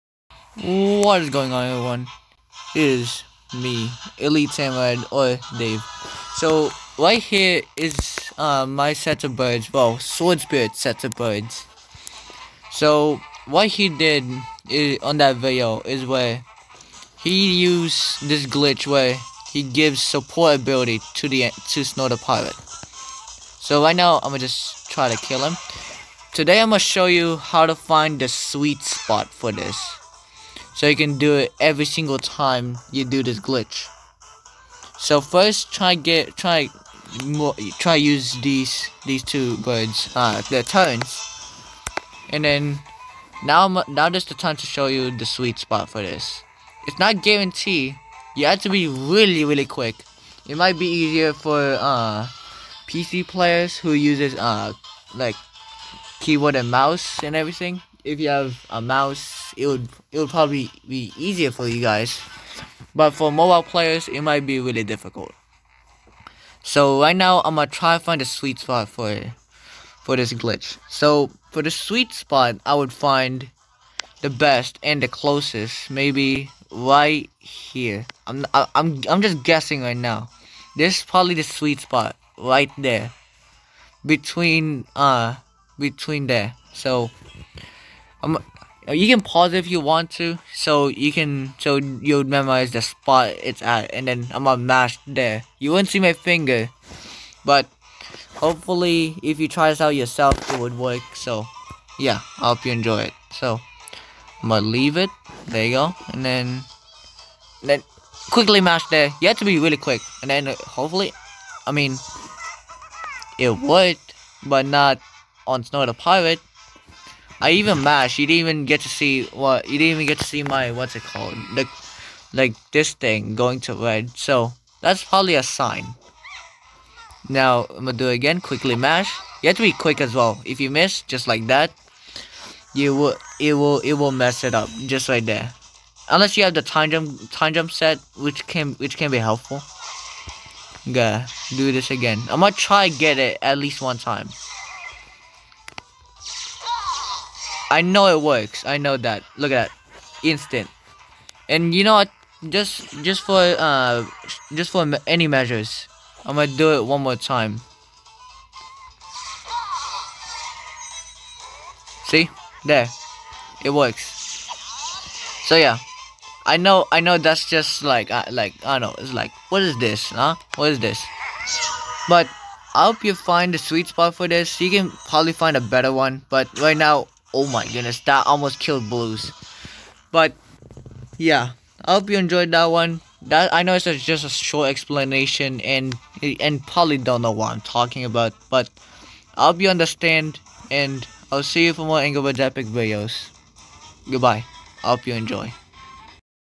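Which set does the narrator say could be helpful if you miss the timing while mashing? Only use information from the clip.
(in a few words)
time jump set.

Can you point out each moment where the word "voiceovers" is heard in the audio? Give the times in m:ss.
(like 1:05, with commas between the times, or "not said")
not said.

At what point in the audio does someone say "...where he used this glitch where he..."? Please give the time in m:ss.
0:16.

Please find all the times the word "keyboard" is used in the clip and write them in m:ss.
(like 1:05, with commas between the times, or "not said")
0:56.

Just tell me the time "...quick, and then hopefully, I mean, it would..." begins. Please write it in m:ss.
1:49.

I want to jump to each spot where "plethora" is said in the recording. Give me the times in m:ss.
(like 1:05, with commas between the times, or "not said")
not said.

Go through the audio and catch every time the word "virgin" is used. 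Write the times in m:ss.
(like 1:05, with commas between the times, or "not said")
not said.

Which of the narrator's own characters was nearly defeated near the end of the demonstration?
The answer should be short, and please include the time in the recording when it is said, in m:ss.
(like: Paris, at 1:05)
Blues, at 2:58.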